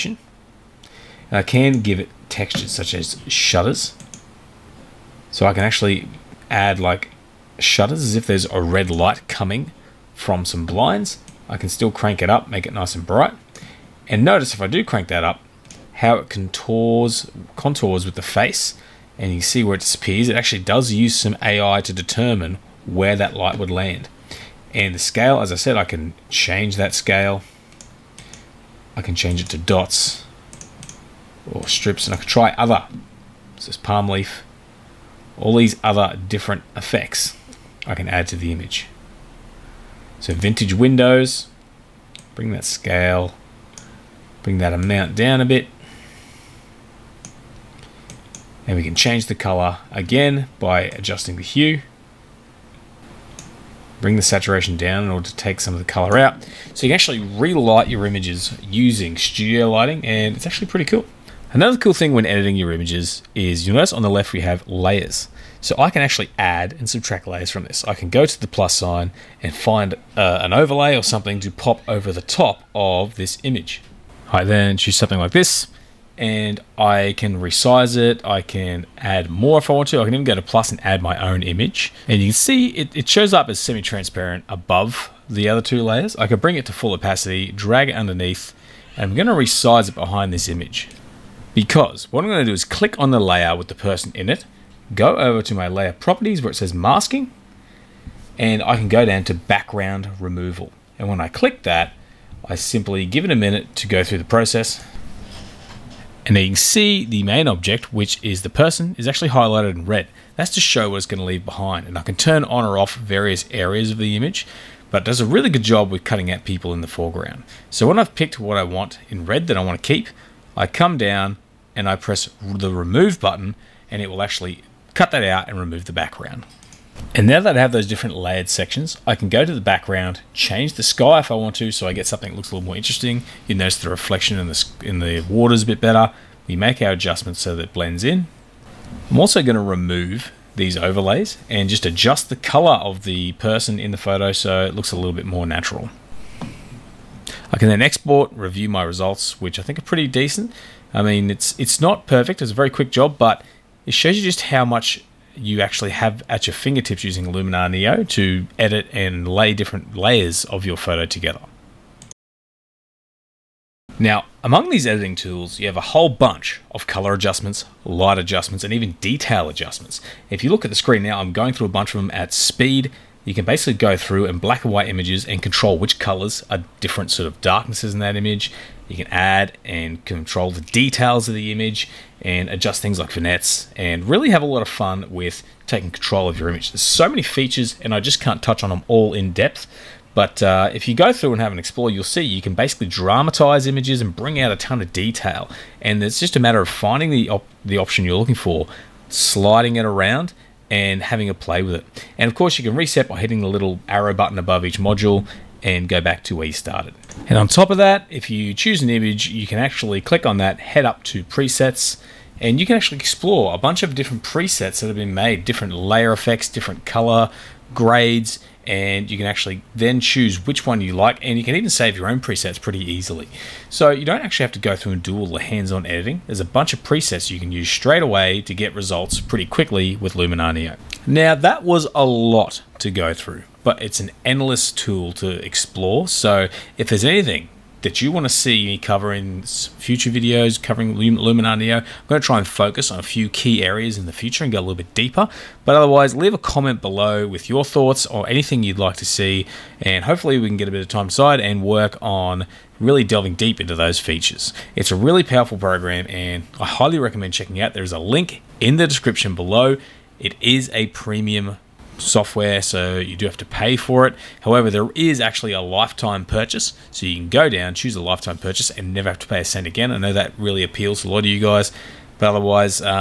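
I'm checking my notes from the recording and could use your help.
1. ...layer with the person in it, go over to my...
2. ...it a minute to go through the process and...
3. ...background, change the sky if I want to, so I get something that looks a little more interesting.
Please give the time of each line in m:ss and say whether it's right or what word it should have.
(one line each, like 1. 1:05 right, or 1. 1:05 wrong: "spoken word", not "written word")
1. 1:33 right
2. 1:43 right
3. 2:09 right.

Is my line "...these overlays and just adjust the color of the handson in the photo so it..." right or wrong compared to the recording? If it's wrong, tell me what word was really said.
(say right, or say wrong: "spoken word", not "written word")
wrong: "person", not "handson".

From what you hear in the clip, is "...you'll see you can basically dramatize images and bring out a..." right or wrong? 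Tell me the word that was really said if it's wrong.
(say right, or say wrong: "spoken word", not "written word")
right.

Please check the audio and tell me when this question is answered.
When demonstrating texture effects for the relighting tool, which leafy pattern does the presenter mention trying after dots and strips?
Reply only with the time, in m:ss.
0:33.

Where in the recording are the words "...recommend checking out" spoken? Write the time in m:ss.
4:16.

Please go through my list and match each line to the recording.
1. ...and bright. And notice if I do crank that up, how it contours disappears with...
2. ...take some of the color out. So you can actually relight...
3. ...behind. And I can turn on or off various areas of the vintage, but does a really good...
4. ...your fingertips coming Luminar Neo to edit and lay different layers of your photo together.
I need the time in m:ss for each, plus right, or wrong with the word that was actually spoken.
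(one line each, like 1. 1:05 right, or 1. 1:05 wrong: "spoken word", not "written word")
1. 0:12 wrong: "contours", not "disappears"
2. 0:55 right
3. 1:51 wrong: "image", not "vintage"
4. 2:36 wrong: "using", not "coming".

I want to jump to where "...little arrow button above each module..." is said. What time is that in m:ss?
3:23.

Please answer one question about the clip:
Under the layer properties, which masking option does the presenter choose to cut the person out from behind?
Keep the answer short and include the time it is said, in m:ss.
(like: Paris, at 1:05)
background removal, at 1:39.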